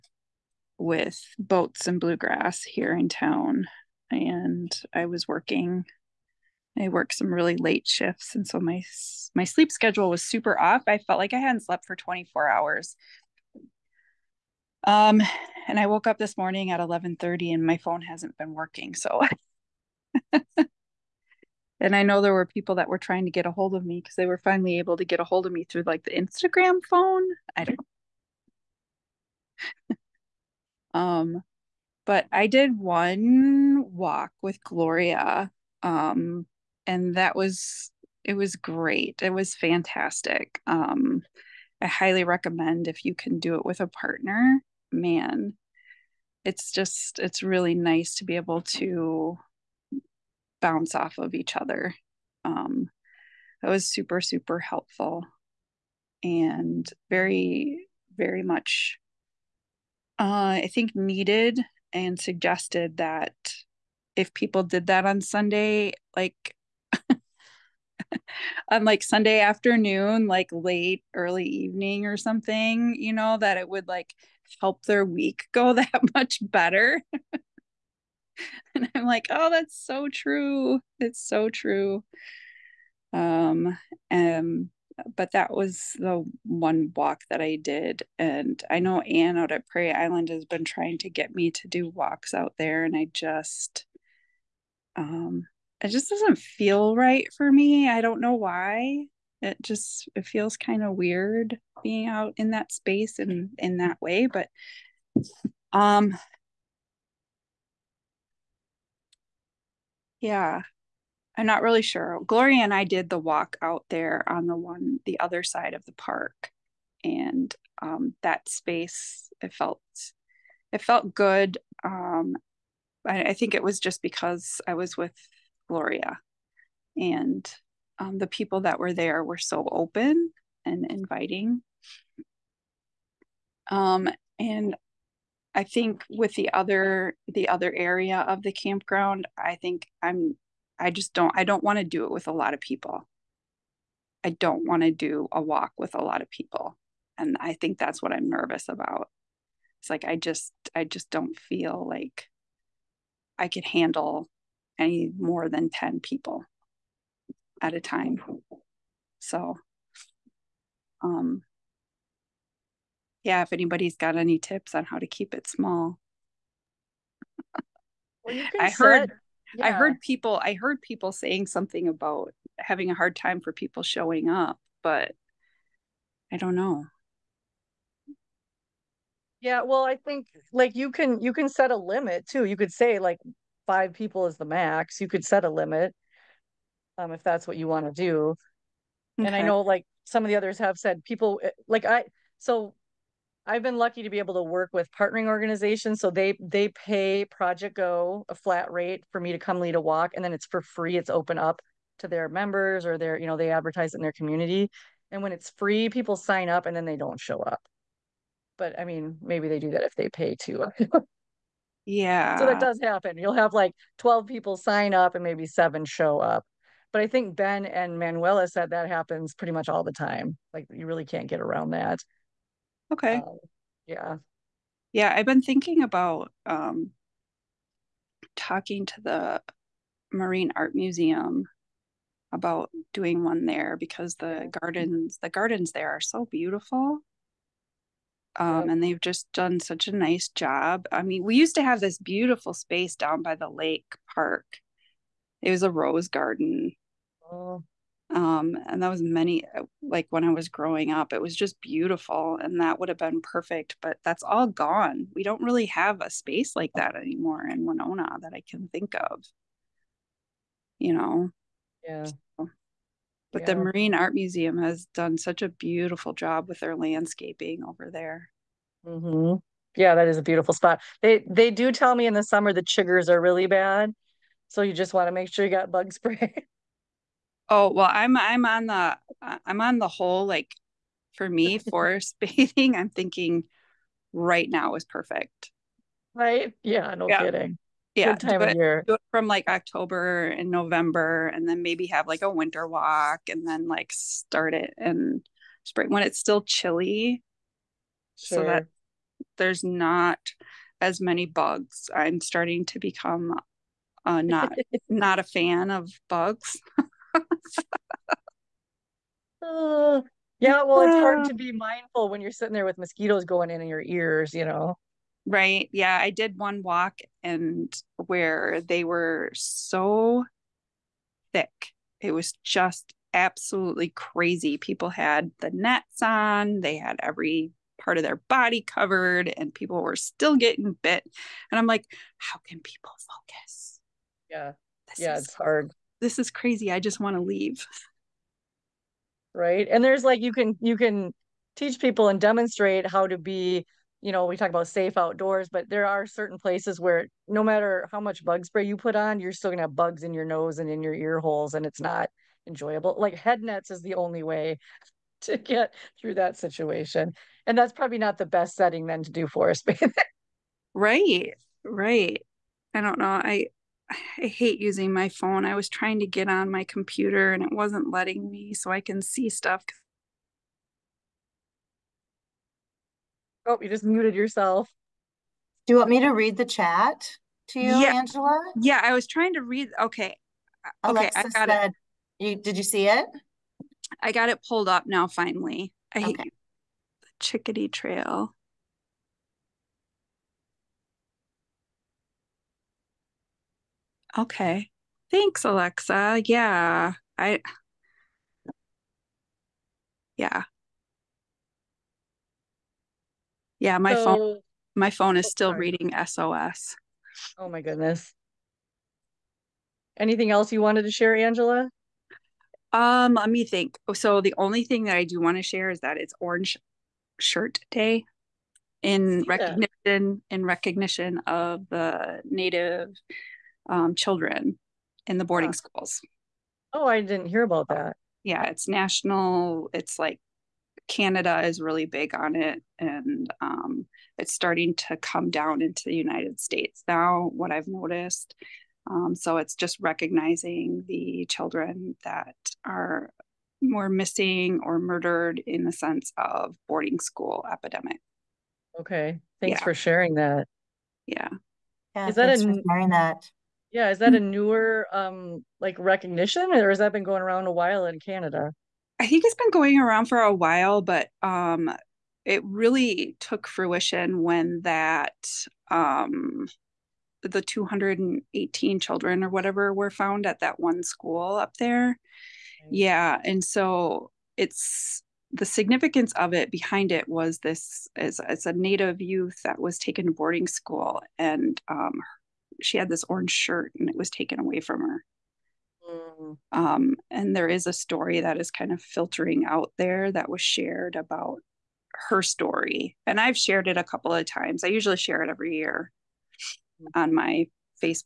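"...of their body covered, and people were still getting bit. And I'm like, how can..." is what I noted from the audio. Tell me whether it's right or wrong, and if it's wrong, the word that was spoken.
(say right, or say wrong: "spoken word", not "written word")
right.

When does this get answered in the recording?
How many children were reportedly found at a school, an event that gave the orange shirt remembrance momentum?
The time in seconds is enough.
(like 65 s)
467 s.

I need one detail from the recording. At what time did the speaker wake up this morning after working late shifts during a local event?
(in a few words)
11:30.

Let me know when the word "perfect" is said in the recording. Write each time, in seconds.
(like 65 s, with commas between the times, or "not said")
253 s, 284 s.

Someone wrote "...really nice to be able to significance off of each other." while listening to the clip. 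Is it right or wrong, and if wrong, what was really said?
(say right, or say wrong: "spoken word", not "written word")
wrong: "bounce", not "significance".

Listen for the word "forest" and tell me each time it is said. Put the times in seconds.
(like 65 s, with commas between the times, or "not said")
281 s, 359 s.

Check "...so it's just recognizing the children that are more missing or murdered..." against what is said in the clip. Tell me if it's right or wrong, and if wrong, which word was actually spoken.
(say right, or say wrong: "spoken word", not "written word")
right.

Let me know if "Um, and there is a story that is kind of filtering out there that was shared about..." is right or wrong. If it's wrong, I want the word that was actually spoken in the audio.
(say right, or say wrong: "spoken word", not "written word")
right.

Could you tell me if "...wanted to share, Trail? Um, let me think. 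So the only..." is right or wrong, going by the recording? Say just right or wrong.
wrong.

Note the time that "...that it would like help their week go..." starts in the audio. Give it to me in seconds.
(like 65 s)
73 s.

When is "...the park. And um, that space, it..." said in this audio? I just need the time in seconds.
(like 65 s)
115 s.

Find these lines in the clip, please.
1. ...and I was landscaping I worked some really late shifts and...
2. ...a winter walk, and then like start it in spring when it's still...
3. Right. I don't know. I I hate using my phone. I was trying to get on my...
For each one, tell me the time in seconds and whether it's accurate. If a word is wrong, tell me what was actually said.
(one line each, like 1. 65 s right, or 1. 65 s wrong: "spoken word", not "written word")
1. 4 s wrong: "working", not "landscaping"
2. 292 s right
3. 361 s right.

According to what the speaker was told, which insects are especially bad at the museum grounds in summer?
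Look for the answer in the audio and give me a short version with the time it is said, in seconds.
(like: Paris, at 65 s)
chiggers, at 272 s.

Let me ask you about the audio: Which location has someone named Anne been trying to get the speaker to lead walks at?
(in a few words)
Prairie Island.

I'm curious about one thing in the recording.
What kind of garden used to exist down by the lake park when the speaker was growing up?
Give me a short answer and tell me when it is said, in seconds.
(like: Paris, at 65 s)
rose garden, at 245 s.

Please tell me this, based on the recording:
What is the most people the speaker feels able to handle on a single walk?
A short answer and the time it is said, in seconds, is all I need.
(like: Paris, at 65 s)
10, at 155 s.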